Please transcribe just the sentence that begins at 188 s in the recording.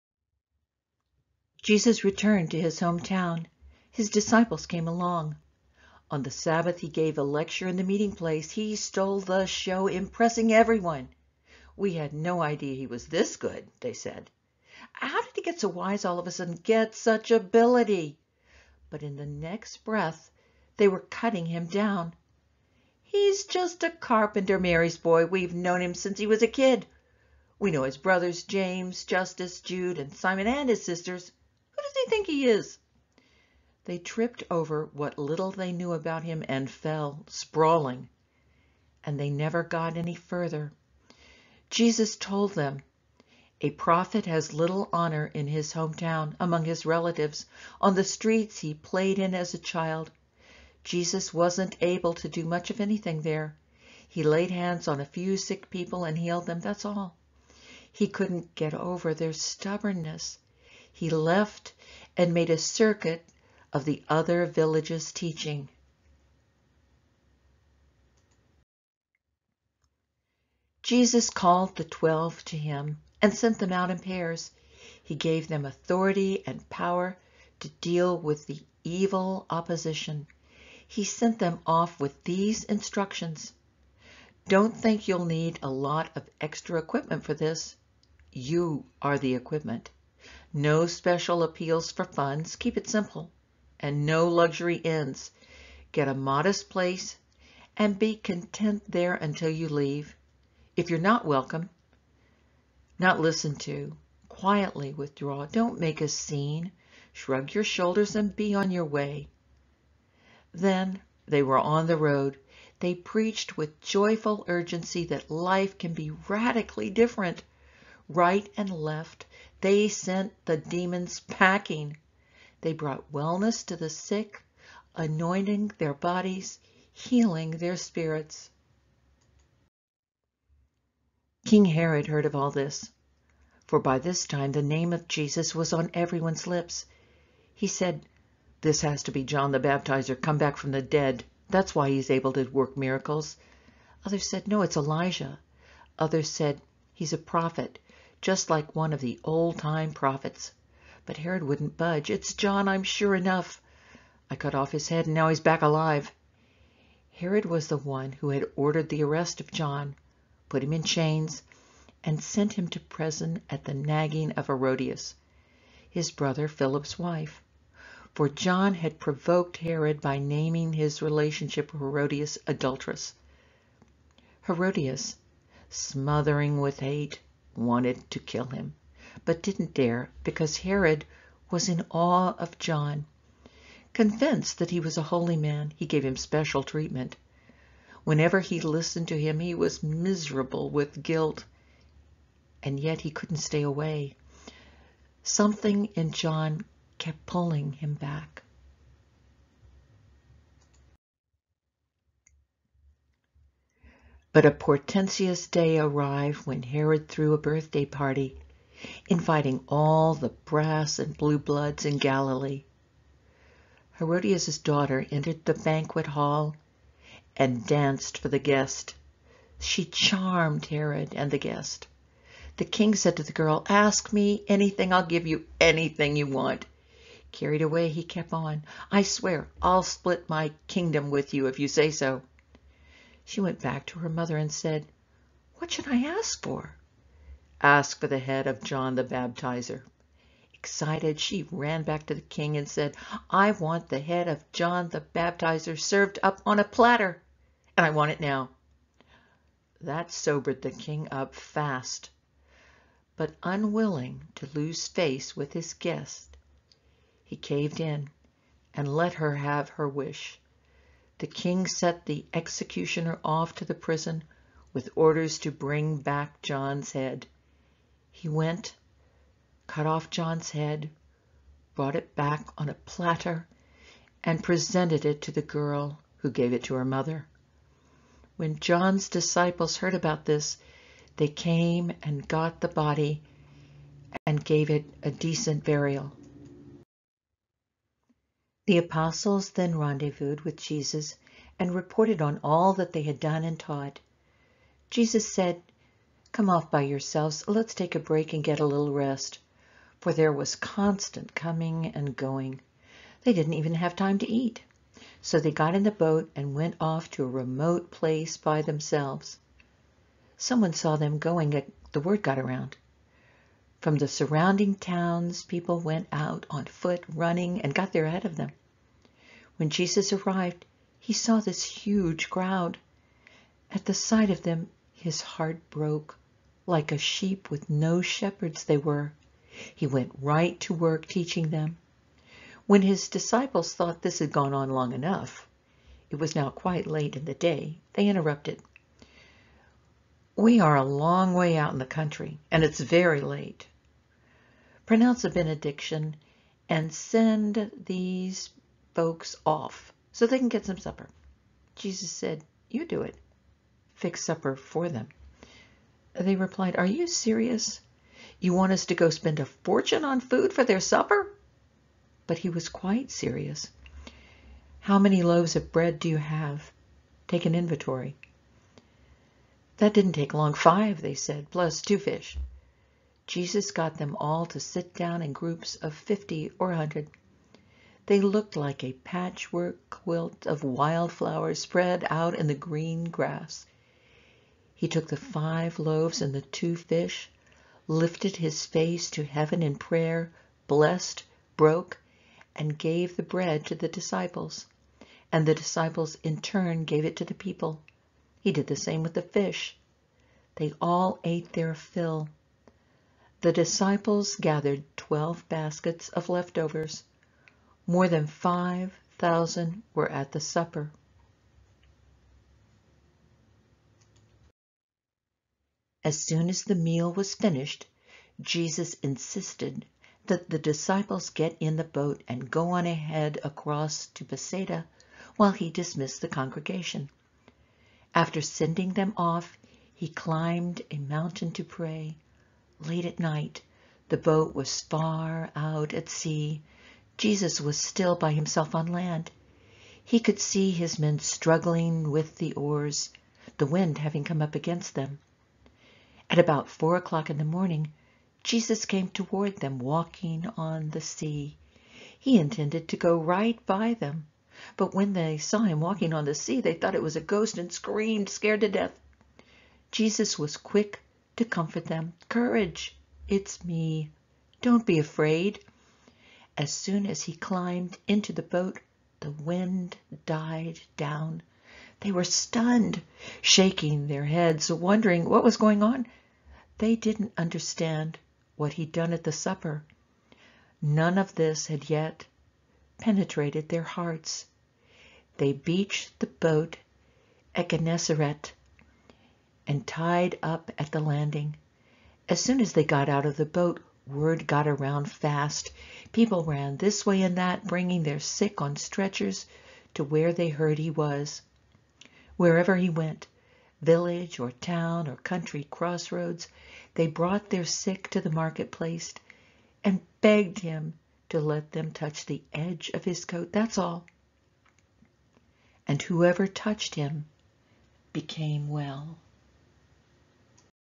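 Whenever he listened to him, he was miserable with guilt, and yet he couldn't stay away.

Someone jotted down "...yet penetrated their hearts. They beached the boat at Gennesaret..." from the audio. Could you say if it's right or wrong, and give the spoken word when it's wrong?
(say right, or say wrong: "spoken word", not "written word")
right.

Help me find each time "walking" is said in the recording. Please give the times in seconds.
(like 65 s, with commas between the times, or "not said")
449 s, 455 s.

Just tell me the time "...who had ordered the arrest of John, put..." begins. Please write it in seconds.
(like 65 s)
158 s.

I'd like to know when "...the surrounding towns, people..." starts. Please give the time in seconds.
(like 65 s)
313 s.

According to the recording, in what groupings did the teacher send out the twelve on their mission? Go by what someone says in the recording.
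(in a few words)
pairs.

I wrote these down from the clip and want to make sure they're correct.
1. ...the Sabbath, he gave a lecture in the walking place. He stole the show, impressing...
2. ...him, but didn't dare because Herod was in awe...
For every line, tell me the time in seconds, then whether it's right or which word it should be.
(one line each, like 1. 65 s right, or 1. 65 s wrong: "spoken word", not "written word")
1. 6 s wrong: "meeting", not "walking"
2. 178 s right.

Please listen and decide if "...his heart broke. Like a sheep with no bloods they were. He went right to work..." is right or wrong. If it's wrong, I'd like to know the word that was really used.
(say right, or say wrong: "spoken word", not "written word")
wrong: "shepherds", not "bloods".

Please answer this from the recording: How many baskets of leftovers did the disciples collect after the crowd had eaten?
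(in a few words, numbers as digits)
12.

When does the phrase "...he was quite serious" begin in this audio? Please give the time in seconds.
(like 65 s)
362 s.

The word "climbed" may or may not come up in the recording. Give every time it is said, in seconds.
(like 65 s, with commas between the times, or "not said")
430 s, 467 s.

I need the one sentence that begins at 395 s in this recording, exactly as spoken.
And the disciples in turn gave it to the people.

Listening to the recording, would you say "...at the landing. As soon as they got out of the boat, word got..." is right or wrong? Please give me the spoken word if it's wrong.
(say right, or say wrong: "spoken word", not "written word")
right.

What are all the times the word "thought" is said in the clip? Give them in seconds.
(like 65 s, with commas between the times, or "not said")
333 s, 456 s.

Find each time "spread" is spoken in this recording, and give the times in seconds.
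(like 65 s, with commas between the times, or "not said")
381 s.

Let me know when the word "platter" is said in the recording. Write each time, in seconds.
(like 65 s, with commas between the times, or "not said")
246 s, 272 s.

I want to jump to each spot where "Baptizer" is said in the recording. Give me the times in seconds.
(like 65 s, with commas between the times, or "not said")
139 s, 239 s, 245 s.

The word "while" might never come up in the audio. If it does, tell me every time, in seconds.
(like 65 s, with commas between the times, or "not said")
425 s.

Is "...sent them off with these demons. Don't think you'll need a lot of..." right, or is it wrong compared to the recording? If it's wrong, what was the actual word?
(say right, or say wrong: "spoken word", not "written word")
wrong: "instructions", not "demons".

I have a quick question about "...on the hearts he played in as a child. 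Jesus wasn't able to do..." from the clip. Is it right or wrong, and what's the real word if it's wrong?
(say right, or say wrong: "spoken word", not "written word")
wrong: "streets", not "hearts".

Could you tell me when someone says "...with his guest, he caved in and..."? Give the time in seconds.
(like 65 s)
255 s.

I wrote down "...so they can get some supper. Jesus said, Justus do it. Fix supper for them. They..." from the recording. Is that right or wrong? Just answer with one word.
wrong.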